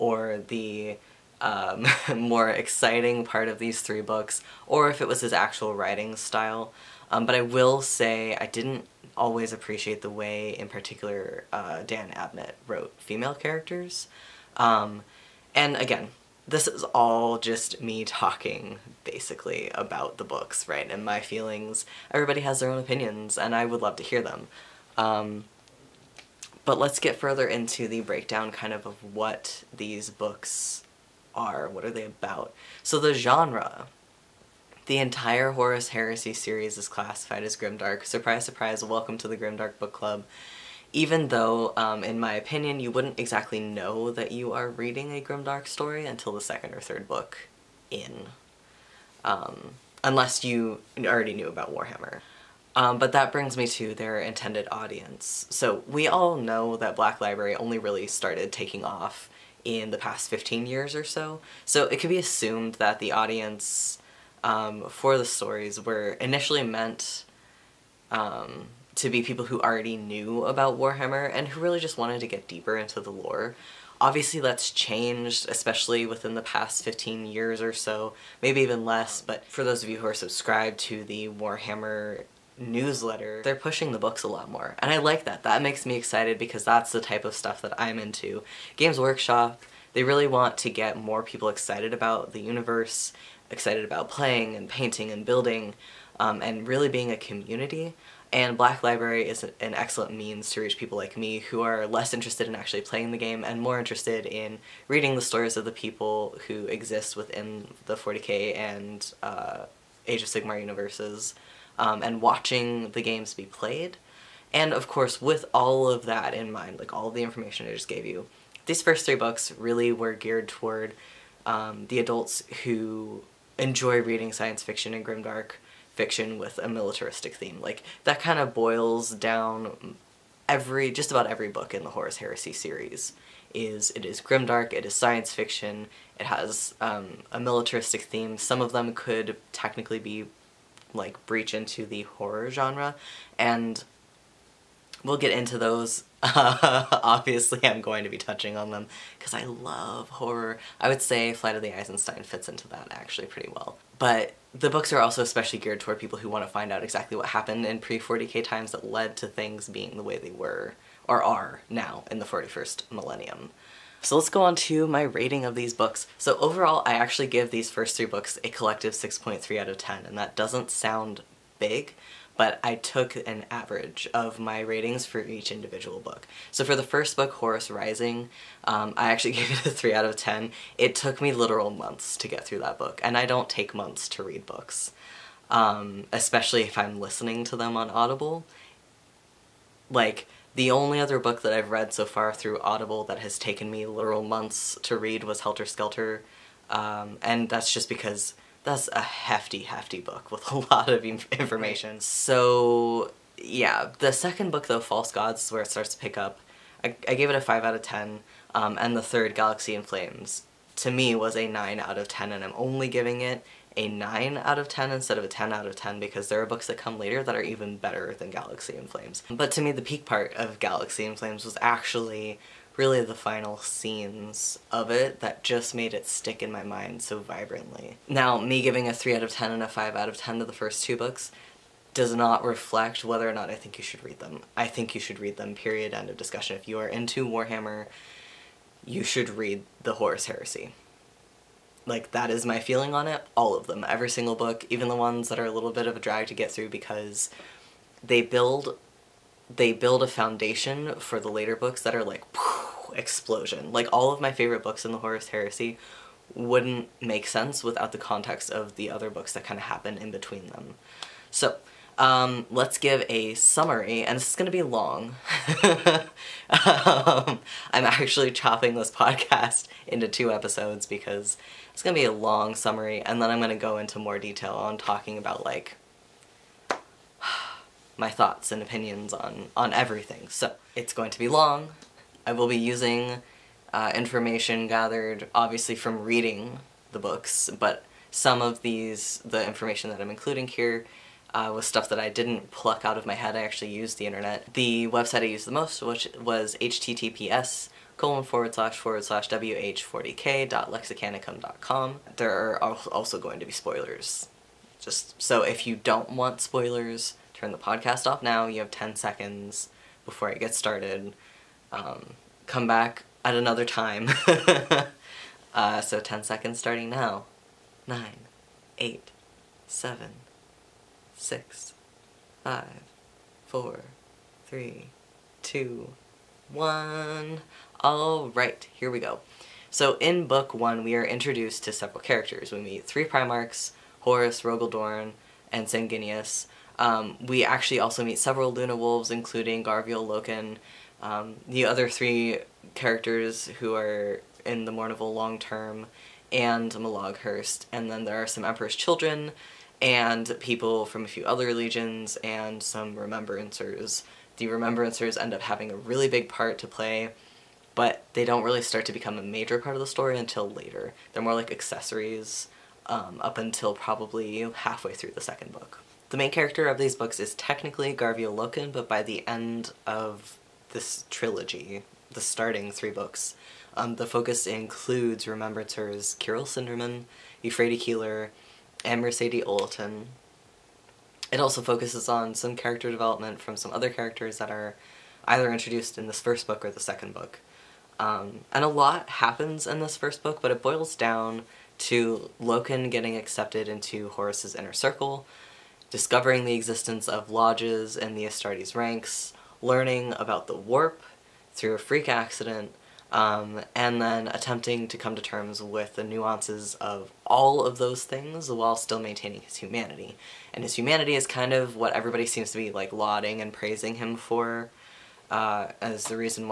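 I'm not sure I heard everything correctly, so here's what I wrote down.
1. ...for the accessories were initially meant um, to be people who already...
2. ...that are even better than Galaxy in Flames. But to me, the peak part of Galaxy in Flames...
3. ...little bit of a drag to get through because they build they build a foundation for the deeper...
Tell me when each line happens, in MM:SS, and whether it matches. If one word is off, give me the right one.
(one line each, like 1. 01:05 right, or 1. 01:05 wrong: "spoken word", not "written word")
1. 01:04 wrong: "stories", not "accessories"
2. 03:37 right
3. 04:05 wrong: "later", not "deeper".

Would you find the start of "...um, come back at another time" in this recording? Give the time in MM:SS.
05:11.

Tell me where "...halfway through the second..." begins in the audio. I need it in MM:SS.
06:04.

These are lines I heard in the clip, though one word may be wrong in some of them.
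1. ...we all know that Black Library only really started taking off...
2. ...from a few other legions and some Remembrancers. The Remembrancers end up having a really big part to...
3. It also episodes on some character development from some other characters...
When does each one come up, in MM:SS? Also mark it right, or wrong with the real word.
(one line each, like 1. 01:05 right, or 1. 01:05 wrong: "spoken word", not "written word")
1. 00:55 right
2. 05:50 right
3. 06:21 wrong: "focuses", not "episodes".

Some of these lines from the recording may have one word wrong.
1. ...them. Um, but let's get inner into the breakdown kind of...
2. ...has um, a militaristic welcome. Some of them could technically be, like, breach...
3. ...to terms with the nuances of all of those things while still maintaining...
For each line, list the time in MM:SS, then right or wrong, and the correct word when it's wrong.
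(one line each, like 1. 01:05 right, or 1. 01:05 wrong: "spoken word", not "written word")
1. 00:24 wrong: "further", not "inner"
2. 02:16 wrong: "theme", not "welcome"
3. 06:45 right.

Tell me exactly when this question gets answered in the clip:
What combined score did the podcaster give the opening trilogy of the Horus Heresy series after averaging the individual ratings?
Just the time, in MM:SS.
02:48.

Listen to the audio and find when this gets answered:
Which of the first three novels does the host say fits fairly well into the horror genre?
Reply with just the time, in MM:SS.
02:31.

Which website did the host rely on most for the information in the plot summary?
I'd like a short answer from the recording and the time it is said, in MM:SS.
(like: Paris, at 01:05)
wh40k.lexicanicum.com, at 04:59.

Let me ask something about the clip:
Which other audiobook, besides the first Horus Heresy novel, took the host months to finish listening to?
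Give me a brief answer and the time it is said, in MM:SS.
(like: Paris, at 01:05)
Helter Skelter, at 03:15.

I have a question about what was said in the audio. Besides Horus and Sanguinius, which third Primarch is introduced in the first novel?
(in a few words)
Rogal Dorn.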